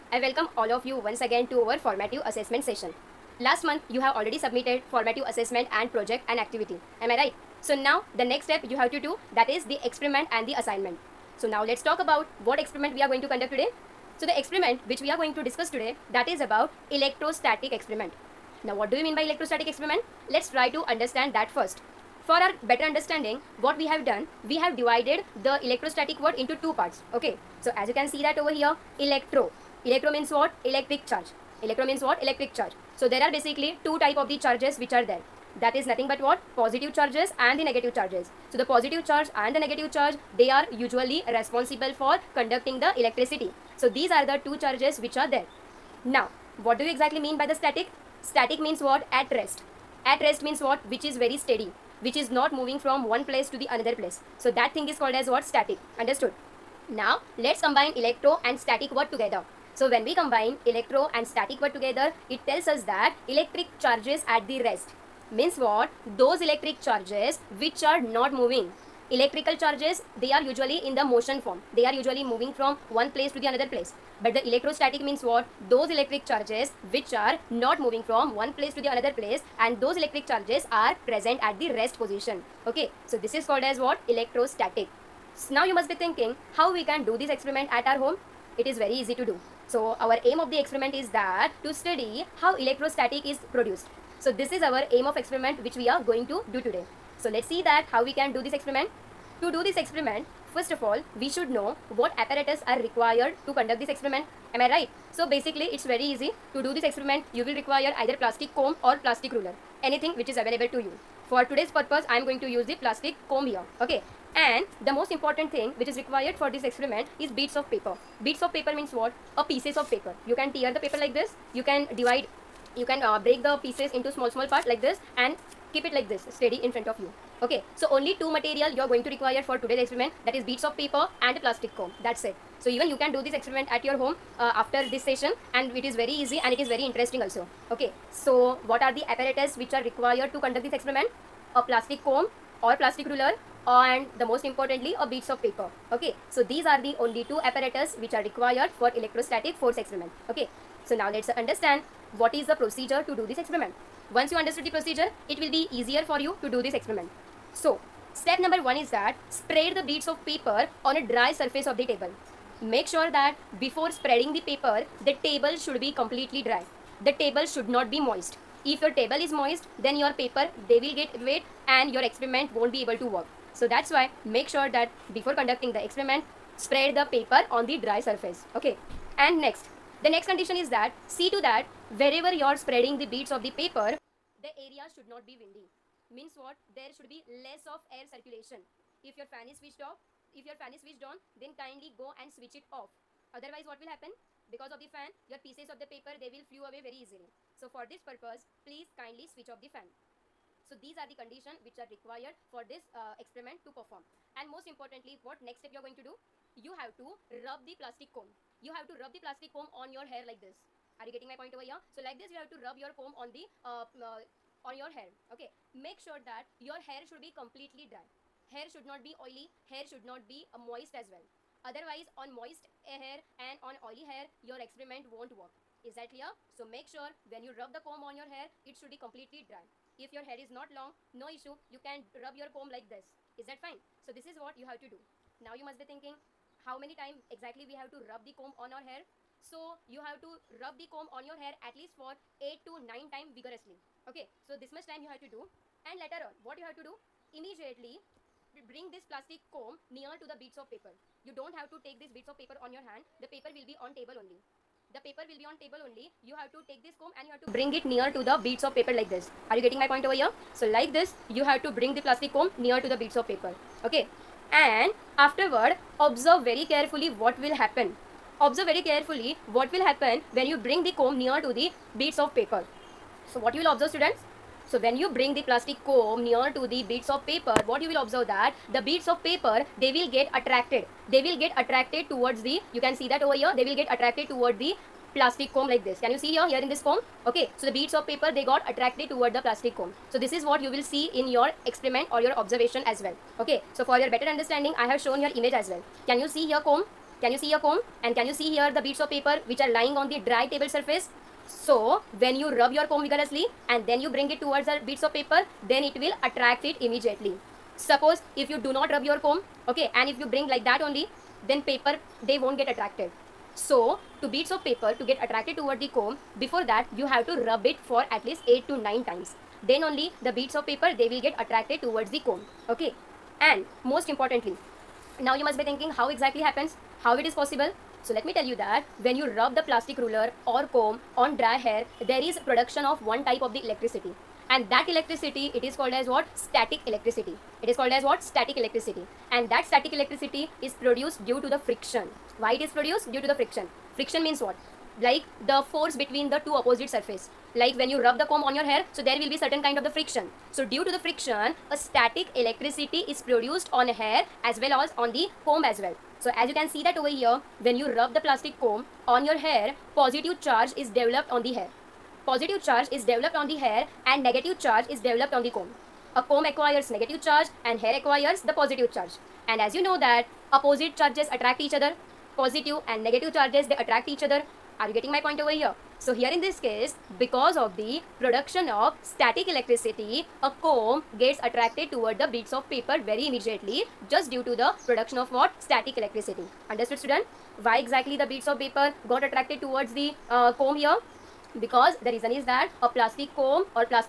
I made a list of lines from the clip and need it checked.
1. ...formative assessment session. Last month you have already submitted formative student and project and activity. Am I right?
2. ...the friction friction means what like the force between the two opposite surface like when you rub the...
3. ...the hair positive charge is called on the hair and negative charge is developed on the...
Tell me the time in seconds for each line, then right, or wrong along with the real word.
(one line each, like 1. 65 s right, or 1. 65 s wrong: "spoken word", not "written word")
1. 1 s wrong: "assessment", not "student"
2. 343 s right
3. 361 s wrong: "developed", not "called".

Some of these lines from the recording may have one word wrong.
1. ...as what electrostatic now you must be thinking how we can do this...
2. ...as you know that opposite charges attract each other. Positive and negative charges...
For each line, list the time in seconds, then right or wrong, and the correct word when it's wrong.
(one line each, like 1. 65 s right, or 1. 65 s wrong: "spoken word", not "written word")
1. 83 s right
2. 369 s right.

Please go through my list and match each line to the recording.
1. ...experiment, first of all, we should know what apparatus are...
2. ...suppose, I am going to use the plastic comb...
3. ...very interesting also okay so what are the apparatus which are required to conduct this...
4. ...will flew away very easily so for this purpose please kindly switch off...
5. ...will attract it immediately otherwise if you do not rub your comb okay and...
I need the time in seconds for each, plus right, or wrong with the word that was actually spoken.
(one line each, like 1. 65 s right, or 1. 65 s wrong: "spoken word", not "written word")
1. 99 s right
2. 111 s wrong: "purpose", not "suppose"
3. 136 s right
4. 196 s right
5. 305 s wrong: "suppose", not "otherwise".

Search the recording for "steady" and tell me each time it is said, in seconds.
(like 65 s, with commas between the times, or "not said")
51 s, 126 s.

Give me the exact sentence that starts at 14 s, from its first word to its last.
So the experiment which we are going to discuss today that is about electrostatic experiment.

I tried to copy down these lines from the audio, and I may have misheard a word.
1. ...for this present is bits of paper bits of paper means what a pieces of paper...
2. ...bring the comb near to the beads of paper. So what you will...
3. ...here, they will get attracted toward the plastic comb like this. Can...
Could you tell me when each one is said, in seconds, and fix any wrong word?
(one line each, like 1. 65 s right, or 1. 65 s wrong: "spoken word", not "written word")
1. 116 s wrong: "experiment", not "present"
2. 270 s right
3. 283 s right.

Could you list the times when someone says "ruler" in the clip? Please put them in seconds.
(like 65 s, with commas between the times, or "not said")
109 s, 143 s, 329 s.